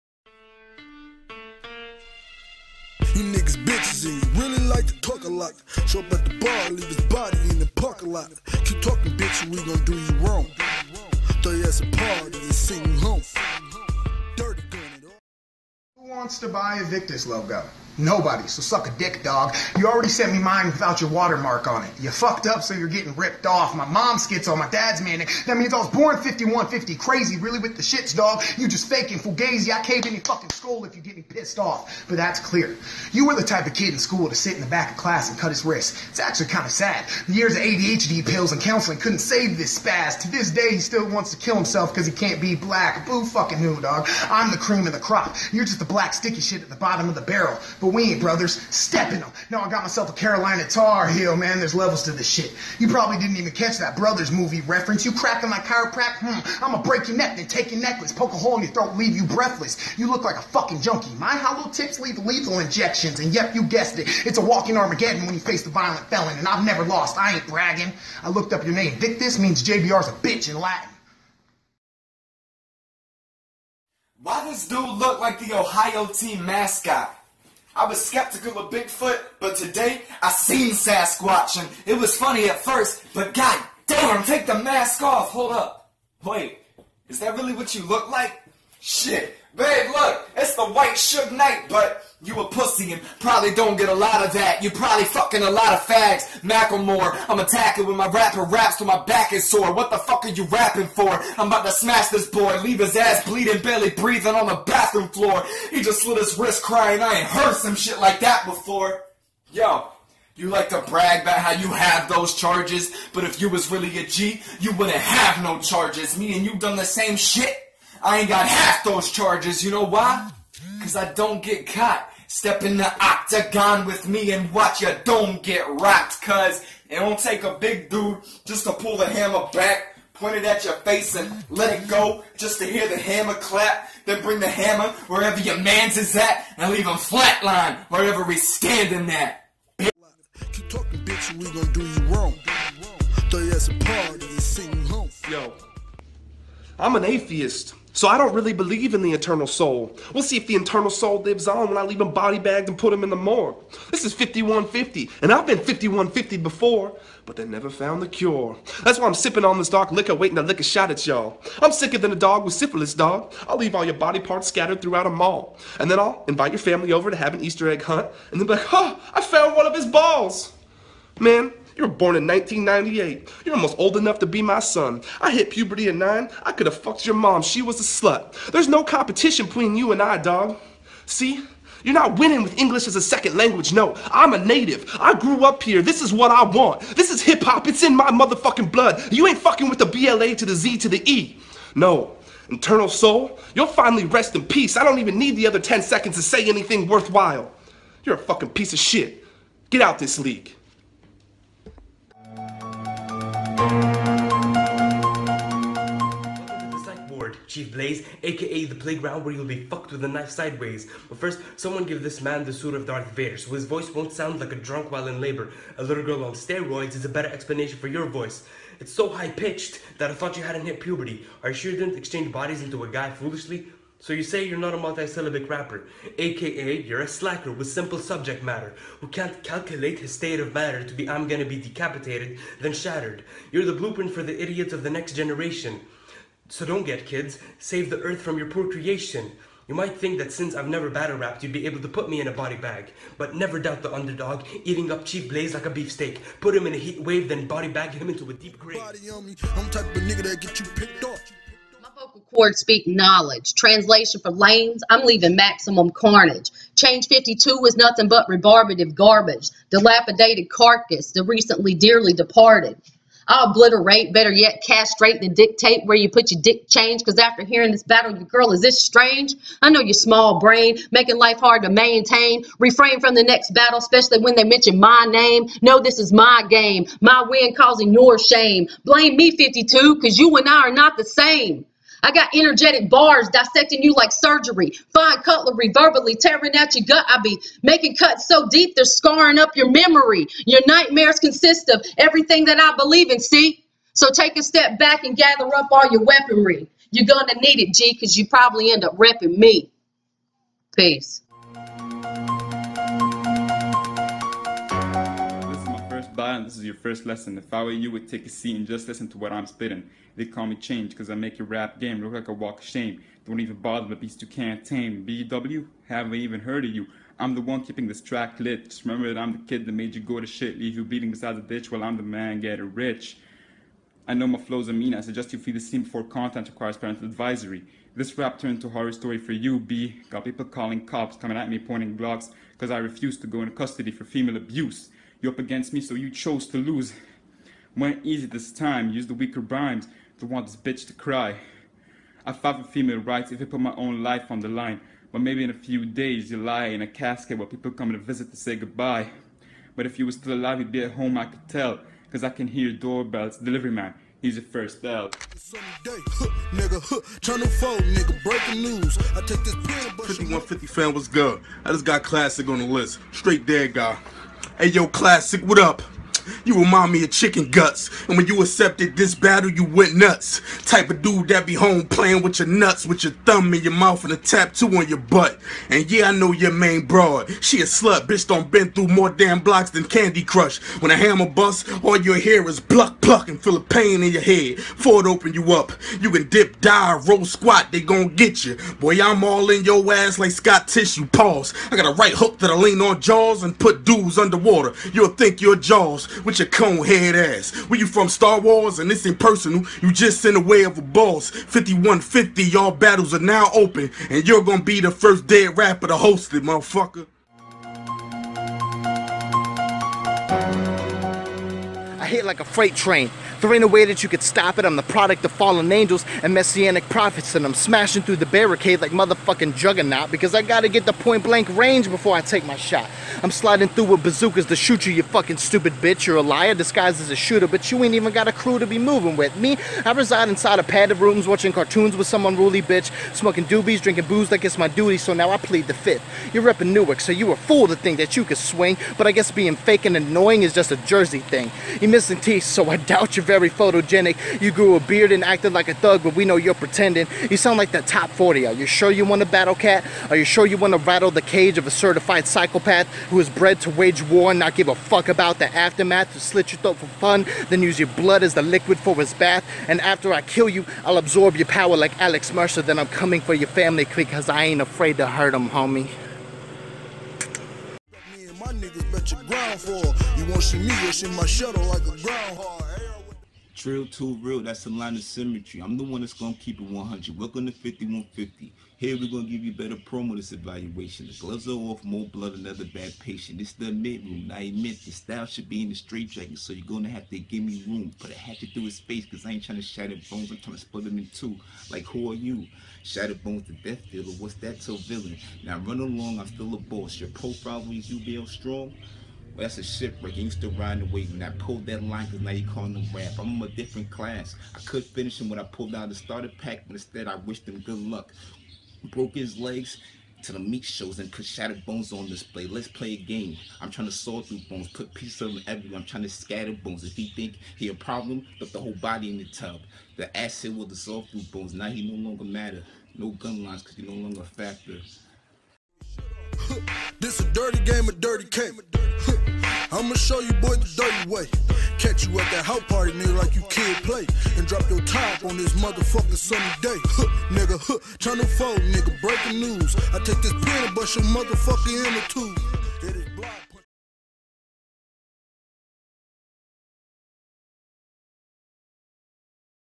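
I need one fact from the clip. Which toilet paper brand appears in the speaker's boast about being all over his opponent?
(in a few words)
Scott Tissue.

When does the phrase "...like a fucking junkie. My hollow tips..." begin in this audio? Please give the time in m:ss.
1:00.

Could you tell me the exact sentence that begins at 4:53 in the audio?
So take a step back and gather up all your weaponry.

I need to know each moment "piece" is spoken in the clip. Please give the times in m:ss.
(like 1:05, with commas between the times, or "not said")
3:18, 8:34.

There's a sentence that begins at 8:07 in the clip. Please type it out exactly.
Put a hatchet through his face because I ain't trying to shatter bones.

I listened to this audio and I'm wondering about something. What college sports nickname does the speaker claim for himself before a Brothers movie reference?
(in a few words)
Carolina Tar Heel.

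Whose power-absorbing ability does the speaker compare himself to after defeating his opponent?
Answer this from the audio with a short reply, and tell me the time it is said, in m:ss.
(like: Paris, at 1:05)
Alex Mercer, at 7:42.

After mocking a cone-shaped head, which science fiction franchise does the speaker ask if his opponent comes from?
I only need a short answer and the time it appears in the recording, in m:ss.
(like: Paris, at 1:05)
Star Wars, at 6:38.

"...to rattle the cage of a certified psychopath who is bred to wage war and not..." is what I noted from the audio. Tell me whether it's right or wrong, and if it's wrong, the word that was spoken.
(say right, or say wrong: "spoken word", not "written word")
right.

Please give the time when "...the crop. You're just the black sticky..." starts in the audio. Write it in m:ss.
0:44.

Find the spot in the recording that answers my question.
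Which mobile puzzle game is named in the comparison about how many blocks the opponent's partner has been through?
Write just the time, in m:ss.
6:19.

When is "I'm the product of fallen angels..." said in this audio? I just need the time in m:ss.
6:54.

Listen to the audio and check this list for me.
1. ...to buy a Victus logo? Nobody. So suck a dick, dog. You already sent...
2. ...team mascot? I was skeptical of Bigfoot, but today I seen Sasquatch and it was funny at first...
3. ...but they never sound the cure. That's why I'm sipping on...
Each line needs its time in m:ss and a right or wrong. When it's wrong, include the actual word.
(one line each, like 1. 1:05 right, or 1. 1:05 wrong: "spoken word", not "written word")
1. 0:16 right
2. 1:16 right
3. 2:37 wrong: "found", not "sound".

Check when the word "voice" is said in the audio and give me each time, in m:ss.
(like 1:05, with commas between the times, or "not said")
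3:33, 3:38.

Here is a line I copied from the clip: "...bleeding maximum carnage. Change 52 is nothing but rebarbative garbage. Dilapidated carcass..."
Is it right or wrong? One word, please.
wrong.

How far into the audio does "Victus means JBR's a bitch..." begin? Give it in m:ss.
1:08.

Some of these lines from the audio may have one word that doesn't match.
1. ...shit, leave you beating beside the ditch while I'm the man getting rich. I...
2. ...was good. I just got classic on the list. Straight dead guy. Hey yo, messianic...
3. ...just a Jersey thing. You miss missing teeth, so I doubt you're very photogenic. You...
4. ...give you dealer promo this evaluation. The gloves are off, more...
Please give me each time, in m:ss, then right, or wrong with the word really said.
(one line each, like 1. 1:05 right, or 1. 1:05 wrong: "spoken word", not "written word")
1. 5:20 right
2. 6:00 wrong: "classic", not "messianic"
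3. 7:20 right
4. 7:59 wrong: "better", not "dealer".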